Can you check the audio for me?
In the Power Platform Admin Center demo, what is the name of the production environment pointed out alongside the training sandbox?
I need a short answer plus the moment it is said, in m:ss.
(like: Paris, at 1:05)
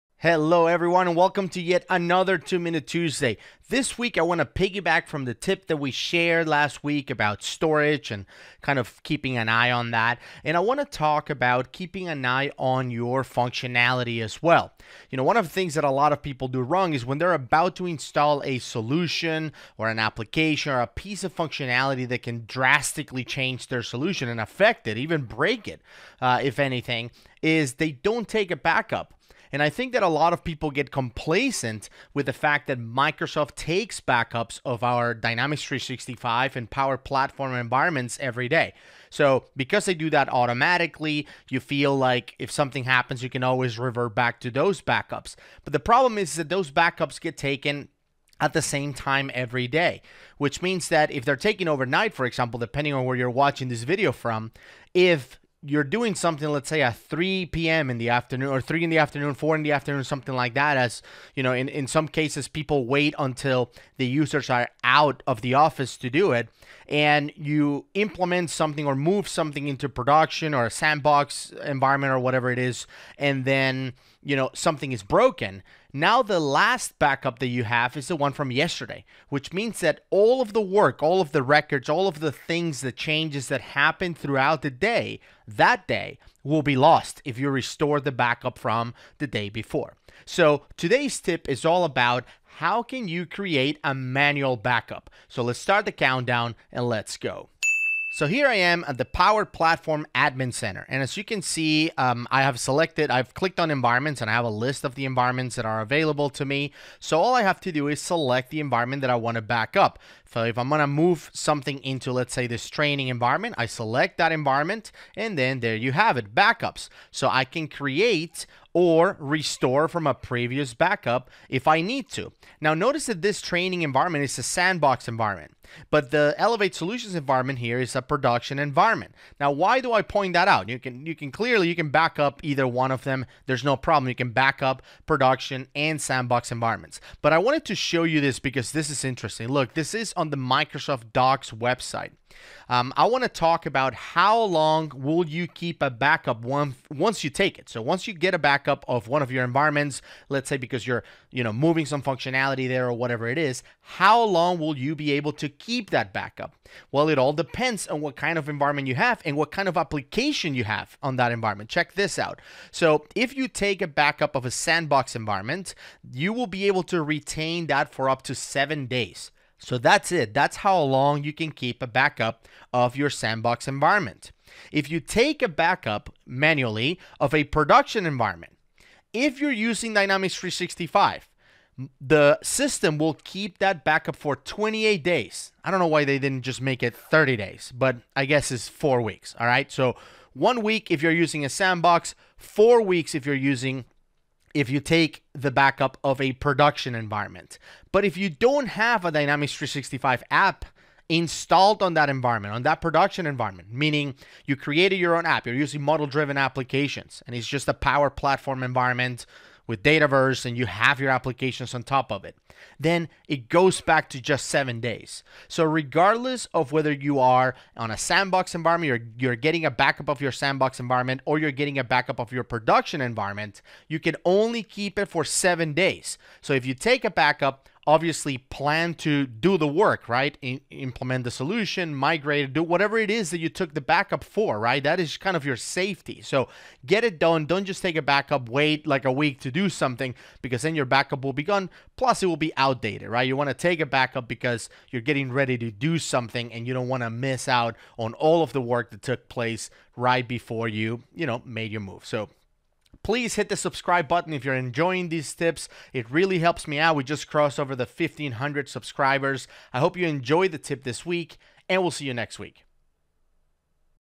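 Elevate Solutions, at 2:06.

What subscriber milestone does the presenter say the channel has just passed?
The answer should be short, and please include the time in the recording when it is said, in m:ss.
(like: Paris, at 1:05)
1500, at 4:17.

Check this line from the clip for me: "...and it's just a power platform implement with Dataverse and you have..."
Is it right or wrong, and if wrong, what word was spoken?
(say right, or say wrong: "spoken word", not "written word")
wrong: "environment", not "implement".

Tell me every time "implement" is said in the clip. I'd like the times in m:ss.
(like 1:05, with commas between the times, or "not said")
1:07, 3:50.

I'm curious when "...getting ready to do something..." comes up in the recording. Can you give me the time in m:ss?
4:05.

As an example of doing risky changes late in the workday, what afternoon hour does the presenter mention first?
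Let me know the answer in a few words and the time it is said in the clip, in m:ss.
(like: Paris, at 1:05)
3 p.m., at 0:56.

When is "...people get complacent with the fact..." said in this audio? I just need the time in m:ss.
0:30.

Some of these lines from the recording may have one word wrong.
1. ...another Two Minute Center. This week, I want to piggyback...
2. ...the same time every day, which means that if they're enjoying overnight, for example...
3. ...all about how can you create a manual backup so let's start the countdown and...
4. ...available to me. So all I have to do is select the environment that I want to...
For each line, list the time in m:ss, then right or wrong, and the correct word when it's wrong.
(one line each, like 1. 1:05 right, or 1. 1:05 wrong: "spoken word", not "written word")
1. 0:01 wrong: "Tuesday", not "Center"
2. 0:48 wrong: "taking", not "enjoying"
3. 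1:31 right
4. 1:45 right.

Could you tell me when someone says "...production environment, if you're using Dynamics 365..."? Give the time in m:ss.
2:57.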